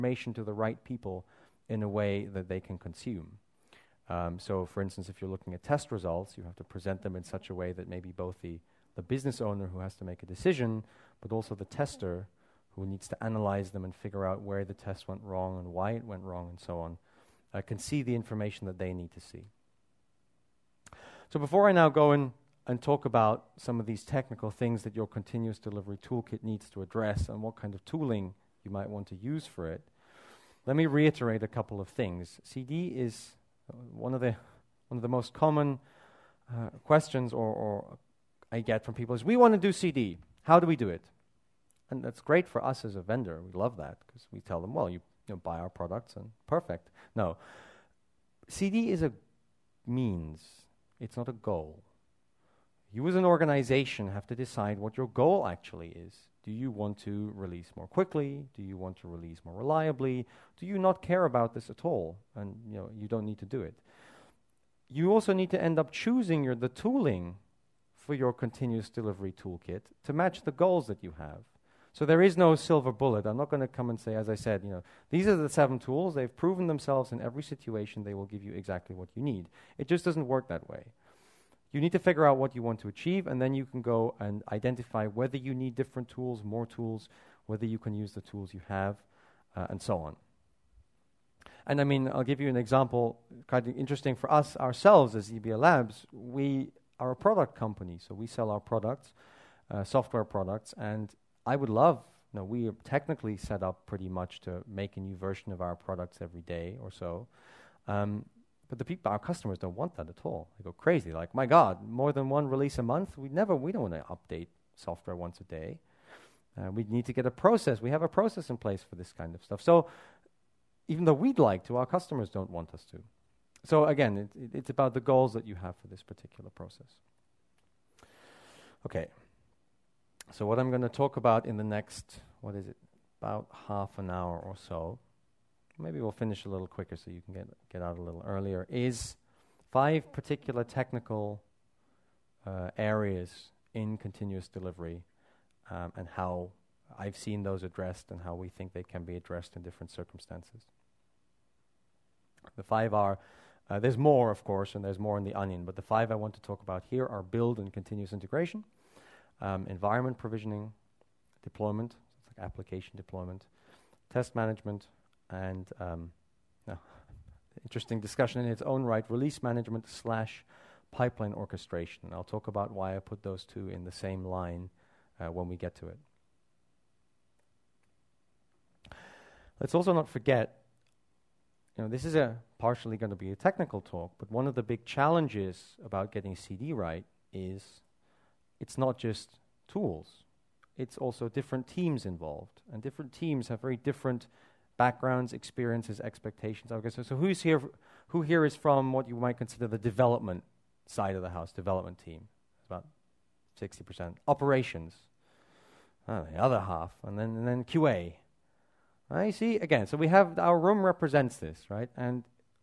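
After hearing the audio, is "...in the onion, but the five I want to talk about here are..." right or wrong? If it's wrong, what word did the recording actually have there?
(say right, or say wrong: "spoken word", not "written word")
right.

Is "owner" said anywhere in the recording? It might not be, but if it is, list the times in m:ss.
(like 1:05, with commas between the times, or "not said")
0:09.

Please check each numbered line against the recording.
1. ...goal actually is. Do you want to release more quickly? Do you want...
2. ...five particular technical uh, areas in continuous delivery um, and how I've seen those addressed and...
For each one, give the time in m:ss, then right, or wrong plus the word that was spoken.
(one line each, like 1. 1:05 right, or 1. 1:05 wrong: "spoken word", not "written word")
1. 0:55 right
2. 2:19 right.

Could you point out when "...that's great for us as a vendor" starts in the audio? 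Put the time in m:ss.
0:42.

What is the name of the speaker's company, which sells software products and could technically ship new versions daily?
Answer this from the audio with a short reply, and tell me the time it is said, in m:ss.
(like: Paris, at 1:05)
XebiaLabs, at 1:35.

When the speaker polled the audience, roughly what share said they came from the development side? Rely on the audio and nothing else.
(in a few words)
60%.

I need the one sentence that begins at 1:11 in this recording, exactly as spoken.
So there is no silver bullet.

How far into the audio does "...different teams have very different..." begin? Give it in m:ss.
3:12.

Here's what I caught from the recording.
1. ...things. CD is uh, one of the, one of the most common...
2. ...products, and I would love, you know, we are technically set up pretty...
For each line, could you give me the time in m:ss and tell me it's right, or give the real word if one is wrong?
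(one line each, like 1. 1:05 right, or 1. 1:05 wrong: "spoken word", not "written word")
1. 0:31 right
2. 1:40 right.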